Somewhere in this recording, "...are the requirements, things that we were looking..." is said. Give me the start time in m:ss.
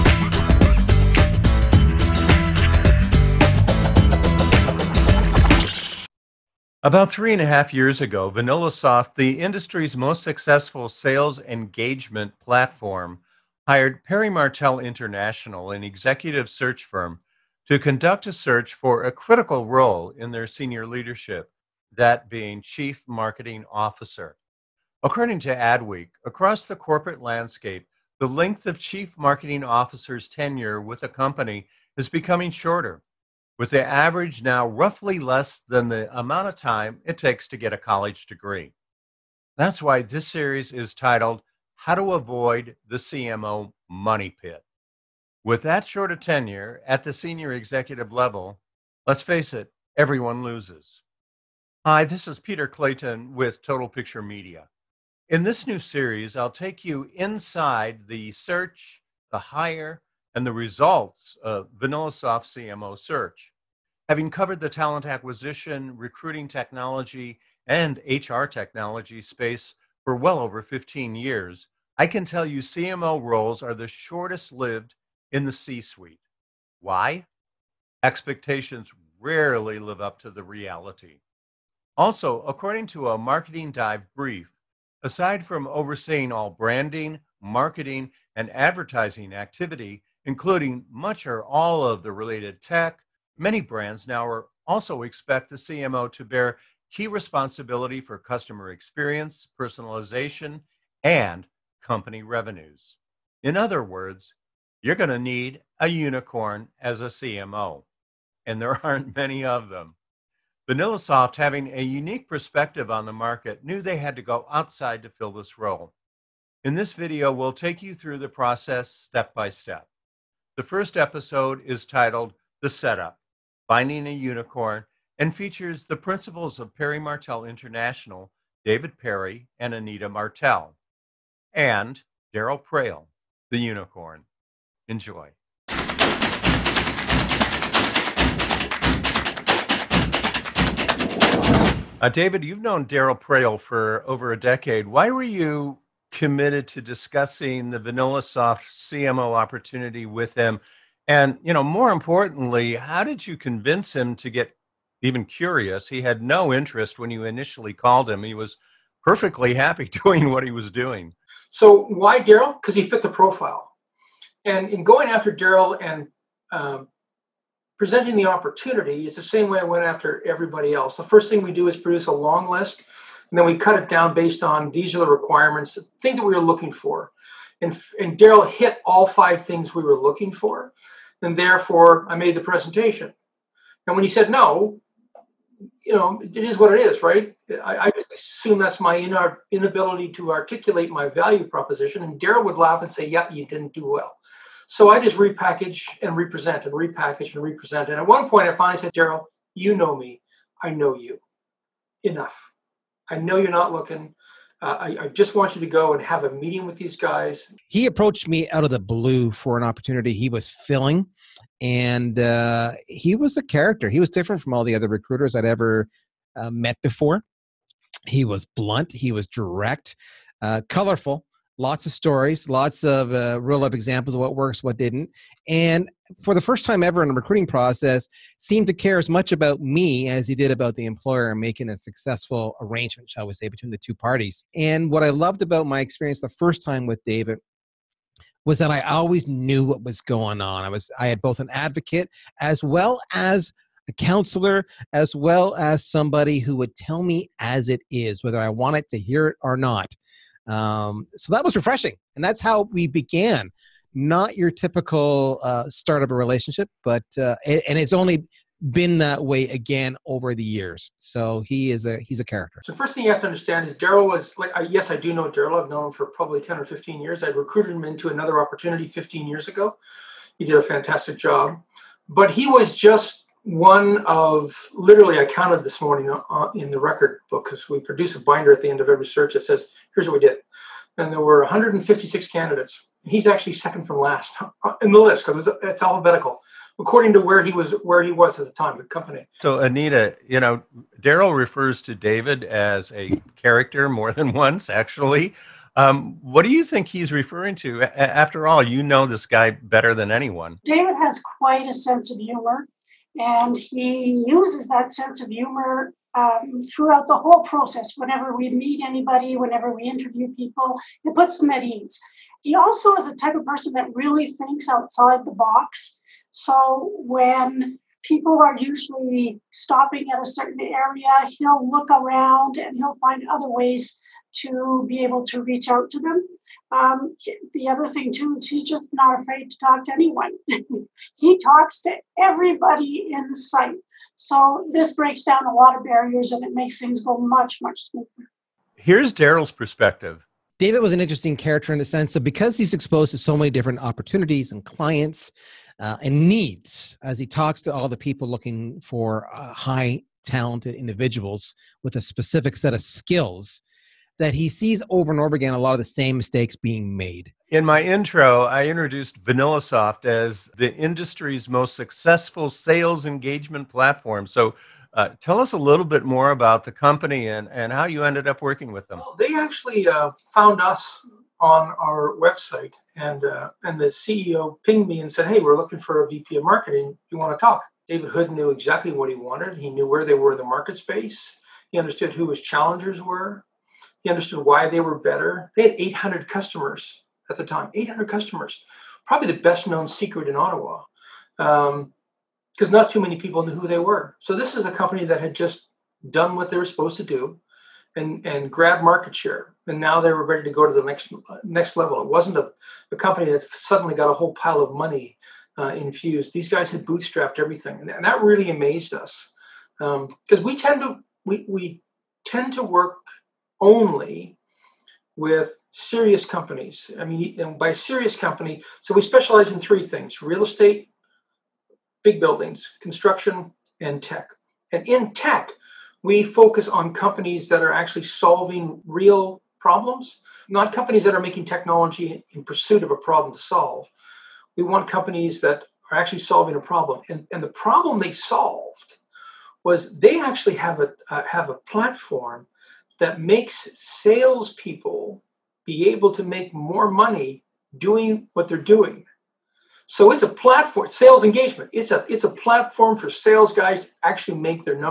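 2:54.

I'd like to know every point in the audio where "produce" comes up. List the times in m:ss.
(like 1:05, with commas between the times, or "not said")
2:51, 4:37.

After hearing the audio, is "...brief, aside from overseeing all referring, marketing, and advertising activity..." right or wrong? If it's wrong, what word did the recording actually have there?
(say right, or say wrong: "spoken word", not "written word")
wrong: "branding", not "referring".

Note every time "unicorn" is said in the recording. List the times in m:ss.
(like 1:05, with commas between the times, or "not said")
1:45, 2:04, 2:13.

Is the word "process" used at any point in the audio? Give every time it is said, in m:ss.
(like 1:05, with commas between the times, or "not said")
1:58, 3:47, 5:07.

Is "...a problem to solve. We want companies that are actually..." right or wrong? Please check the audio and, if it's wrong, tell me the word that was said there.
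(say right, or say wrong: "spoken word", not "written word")
right.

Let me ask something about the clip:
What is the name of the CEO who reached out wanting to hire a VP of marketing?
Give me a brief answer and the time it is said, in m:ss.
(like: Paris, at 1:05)
David Hood, at 6:17.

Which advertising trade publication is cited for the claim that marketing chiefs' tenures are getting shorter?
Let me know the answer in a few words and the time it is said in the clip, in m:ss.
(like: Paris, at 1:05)
Adweek, at 0:25.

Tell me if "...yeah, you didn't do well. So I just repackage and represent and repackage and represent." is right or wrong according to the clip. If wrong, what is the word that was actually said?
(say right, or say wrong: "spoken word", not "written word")
right.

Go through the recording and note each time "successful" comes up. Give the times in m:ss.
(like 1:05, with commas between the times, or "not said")
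0:10, 3:51, 6:01.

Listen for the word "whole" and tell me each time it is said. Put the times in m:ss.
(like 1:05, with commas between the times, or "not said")
5:07, 6:44.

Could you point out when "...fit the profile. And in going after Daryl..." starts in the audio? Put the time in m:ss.
2:42.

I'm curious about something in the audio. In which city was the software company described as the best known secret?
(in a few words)
Ottawa.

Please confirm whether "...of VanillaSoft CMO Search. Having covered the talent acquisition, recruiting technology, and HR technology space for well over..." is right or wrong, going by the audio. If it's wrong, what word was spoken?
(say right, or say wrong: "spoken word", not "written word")
right.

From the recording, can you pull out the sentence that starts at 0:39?
That's why this series is titled How to Avoid the CMO Money Pit.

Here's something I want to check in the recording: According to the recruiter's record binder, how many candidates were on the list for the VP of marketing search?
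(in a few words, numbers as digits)
156.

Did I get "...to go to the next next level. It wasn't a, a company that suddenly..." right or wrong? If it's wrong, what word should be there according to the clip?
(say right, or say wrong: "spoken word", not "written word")
right.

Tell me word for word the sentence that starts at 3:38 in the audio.
He was blunt, he was direct, uh, colorful, lots of stories, lots of uh, real life examples of what works, what didn't.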